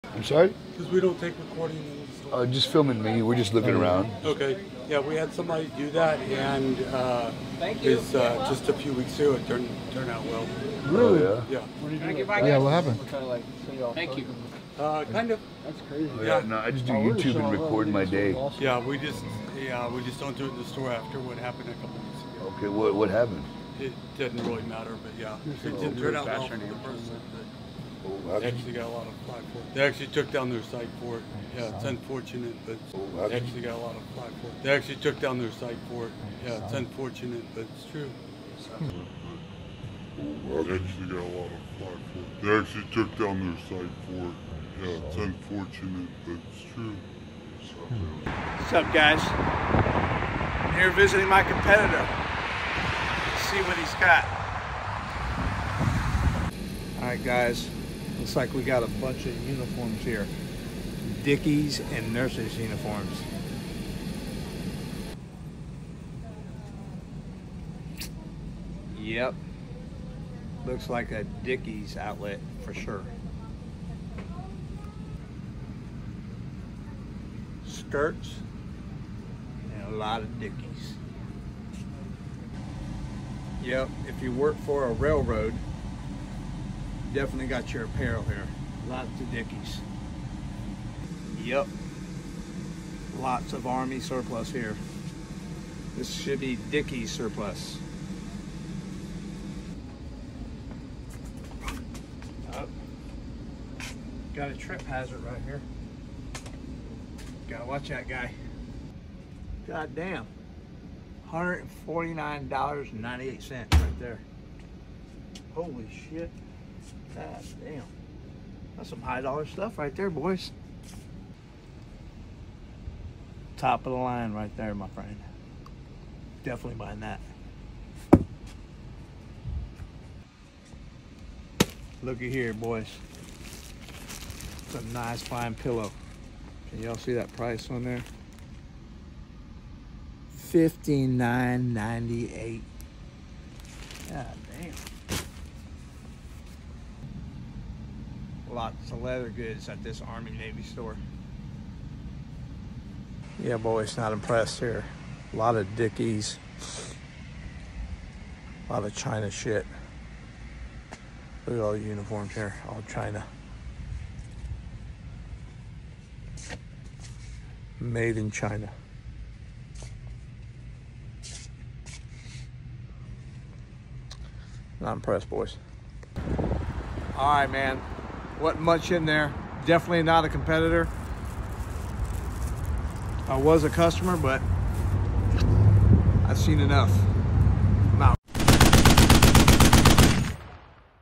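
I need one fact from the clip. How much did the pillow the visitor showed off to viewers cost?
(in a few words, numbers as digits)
$59.98.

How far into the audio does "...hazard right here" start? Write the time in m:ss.
1:44.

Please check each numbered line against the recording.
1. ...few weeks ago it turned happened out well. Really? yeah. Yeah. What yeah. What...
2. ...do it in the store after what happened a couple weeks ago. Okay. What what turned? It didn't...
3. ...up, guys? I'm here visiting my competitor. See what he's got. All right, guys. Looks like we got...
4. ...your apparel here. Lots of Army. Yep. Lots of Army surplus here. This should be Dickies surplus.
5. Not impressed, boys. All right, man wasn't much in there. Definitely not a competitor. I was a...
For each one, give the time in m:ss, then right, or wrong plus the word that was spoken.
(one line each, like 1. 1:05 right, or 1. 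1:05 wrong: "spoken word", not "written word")
1. 0:08 wrong: "turned", not "happened"
2. 0:20 wrong: "happened", not "turned"
3. 0:48 right
4. 1:27 wrong: "Dickies", not "Army"
5. 2:54 right.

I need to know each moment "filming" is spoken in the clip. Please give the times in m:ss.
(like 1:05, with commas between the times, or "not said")
0:02.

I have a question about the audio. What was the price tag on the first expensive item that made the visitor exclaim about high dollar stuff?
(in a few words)
$149.98.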